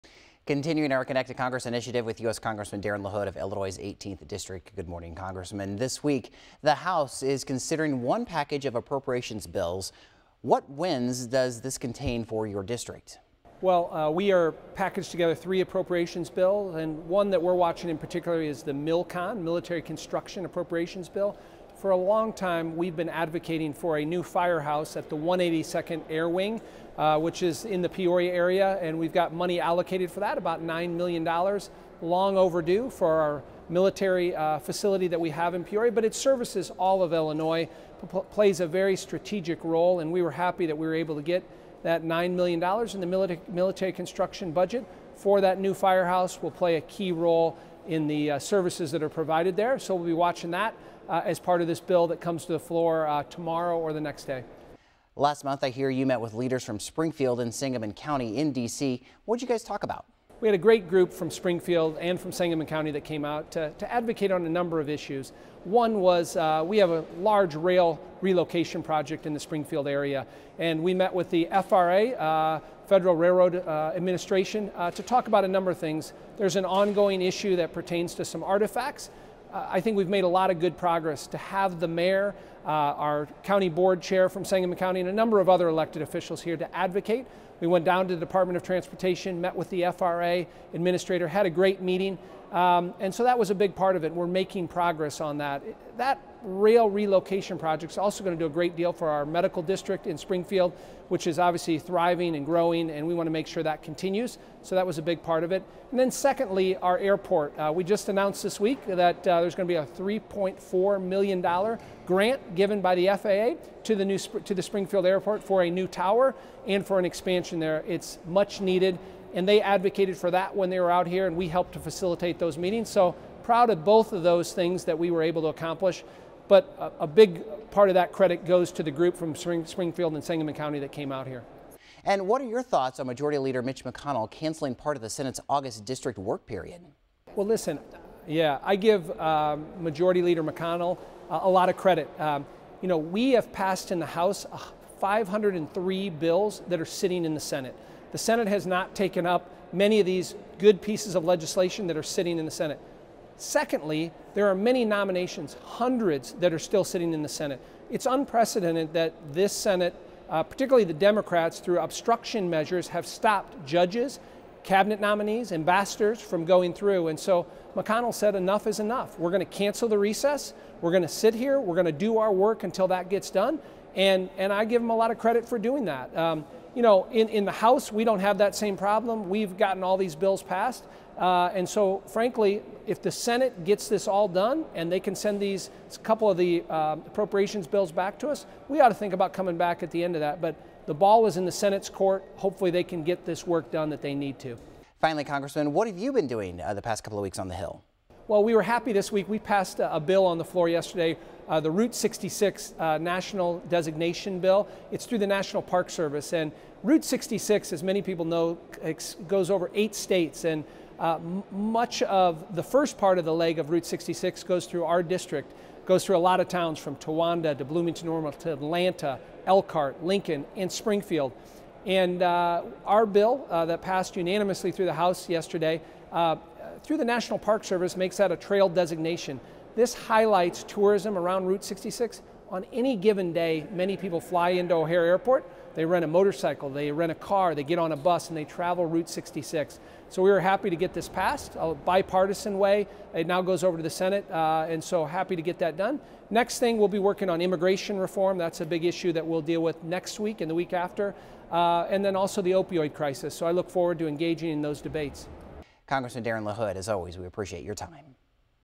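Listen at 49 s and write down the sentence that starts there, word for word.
So we'll be watching that uh, as part of this bill that comes to the floor uh, tomorrow or the next day.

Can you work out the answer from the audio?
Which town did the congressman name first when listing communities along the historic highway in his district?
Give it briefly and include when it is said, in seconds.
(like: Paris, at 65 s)
Towanda, at 216 s.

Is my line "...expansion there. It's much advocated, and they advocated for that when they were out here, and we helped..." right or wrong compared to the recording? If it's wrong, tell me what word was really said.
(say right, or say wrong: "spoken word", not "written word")
wrong: "needed", not "advocated".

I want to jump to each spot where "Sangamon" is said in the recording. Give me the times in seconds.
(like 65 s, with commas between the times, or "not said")
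57 s, 62 s, 84 s, 130 s.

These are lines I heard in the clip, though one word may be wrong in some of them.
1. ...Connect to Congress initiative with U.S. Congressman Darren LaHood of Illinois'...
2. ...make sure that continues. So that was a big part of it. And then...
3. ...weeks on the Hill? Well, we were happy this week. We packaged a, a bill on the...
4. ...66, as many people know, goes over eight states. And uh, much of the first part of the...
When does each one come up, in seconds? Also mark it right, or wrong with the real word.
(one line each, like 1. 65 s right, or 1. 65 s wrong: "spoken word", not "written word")
1. 1 s right
2. 103 s right
3. 197 s wrong: "passed", not "packaged"
4. 207 s right.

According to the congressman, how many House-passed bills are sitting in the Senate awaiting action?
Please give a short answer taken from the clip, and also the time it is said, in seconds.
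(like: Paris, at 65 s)
503, at 144 s.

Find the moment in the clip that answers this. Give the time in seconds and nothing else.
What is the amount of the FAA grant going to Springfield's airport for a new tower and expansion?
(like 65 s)
109 s.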